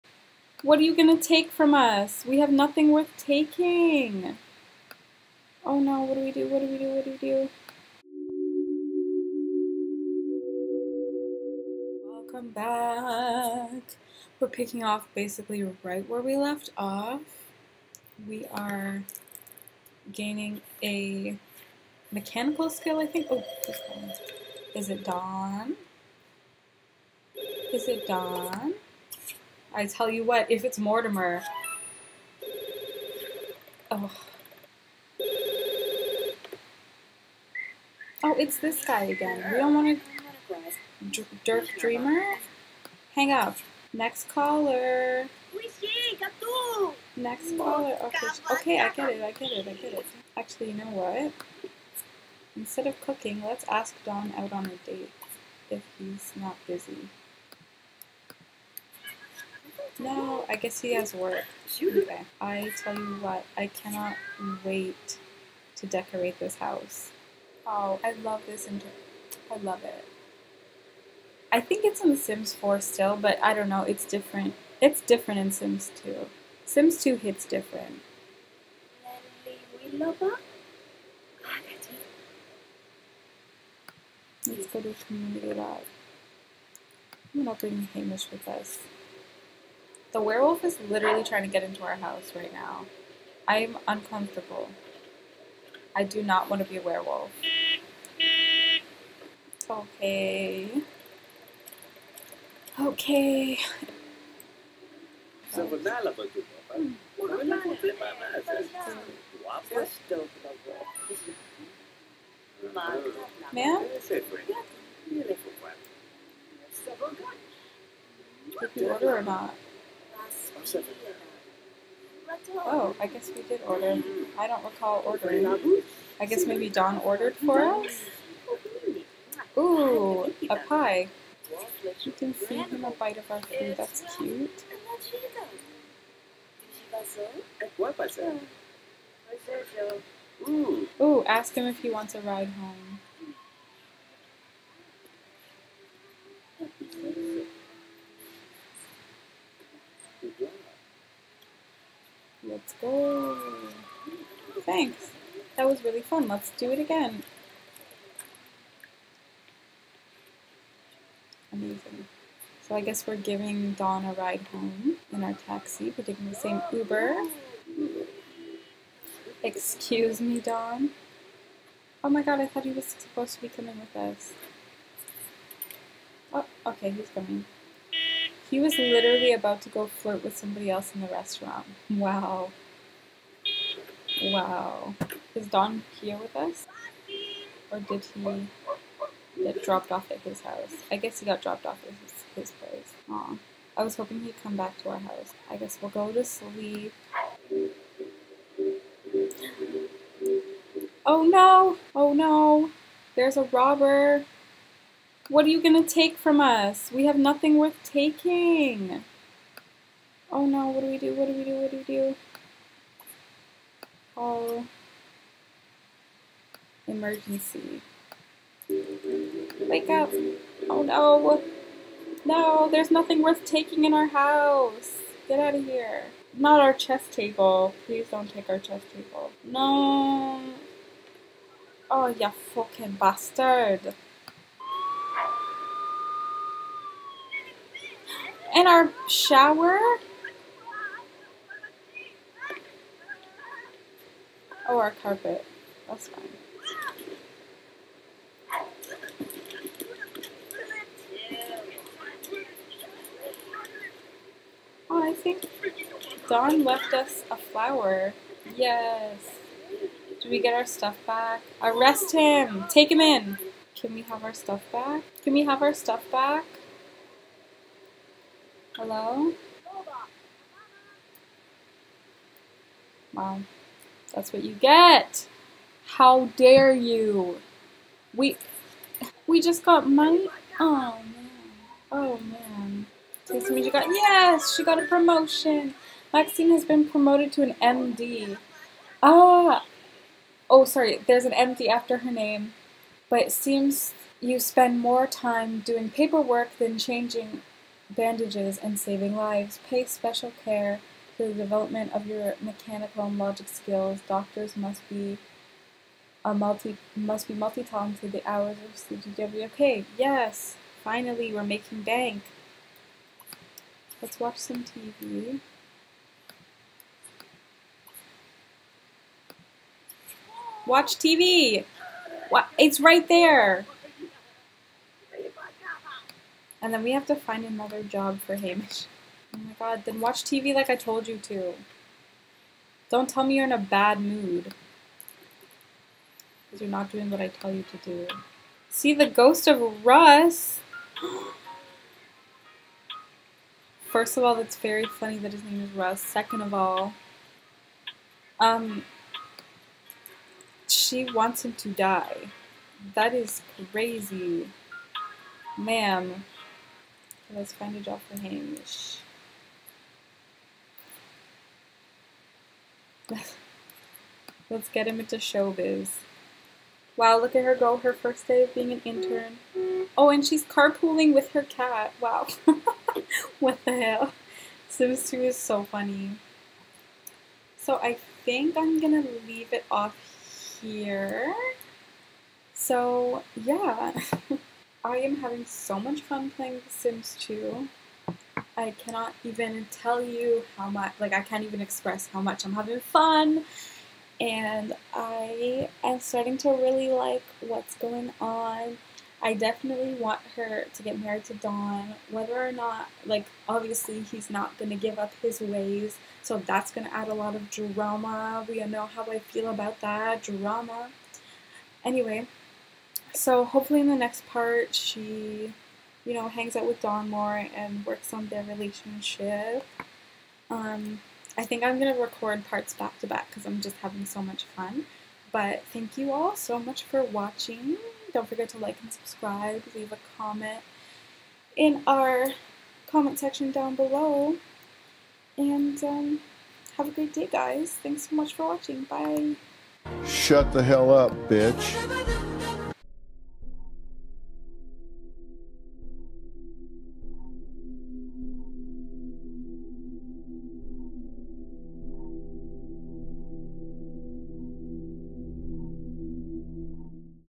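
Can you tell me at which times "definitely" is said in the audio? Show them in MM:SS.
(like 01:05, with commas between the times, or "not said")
06:39.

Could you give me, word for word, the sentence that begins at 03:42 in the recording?
No, there's nothing worth taking in our house.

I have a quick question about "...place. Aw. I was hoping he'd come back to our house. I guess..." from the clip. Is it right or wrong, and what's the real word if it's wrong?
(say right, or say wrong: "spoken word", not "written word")
right.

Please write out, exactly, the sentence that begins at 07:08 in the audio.
Don't forget to like and subscribe, leave a comment in our comment section down below.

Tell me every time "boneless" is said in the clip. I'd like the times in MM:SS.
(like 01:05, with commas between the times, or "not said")
not said.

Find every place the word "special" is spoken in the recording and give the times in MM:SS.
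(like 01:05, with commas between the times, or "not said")
04:59.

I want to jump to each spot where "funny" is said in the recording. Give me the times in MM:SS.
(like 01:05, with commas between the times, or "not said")
05:44, 06:15.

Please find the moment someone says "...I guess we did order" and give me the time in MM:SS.
02:02.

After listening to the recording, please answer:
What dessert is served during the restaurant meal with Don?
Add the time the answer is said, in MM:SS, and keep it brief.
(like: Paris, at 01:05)
A pie, at 02:10.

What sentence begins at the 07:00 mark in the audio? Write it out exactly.
Um, I think I'm going to record parts back to back because I'm just having so much fun.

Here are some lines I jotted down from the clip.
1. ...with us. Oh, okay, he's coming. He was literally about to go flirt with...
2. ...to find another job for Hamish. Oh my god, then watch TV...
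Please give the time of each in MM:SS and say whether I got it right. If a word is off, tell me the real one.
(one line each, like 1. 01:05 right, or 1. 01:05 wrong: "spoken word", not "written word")
1. 02:53 right
2. 05:27 right.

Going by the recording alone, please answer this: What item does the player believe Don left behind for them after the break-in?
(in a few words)
A flower.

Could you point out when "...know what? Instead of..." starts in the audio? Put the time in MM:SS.
00:50.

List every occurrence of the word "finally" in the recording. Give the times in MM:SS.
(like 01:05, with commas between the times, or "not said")
05:10.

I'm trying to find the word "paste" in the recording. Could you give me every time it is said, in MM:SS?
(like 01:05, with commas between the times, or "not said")
not said.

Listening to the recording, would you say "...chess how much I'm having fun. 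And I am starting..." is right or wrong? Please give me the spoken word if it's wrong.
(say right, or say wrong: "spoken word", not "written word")
wrong: "express", not "chess".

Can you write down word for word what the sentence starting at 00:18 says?
We are gaining a mechanical skill, I think.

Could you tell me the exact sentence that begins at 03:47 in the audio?
Please don't take our chess table.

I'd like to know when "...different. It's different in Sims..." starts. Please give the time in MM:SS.
01:14.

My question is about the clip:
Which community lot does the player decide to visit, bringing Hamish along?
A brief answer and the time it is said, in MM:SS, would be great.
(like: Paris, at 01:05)
community lab, at 01:25.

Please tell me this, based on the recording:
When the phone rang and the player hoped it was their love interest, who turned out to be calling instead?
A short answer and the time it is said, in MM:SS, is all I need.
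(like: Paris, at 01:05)
Mortimer, at 00:30.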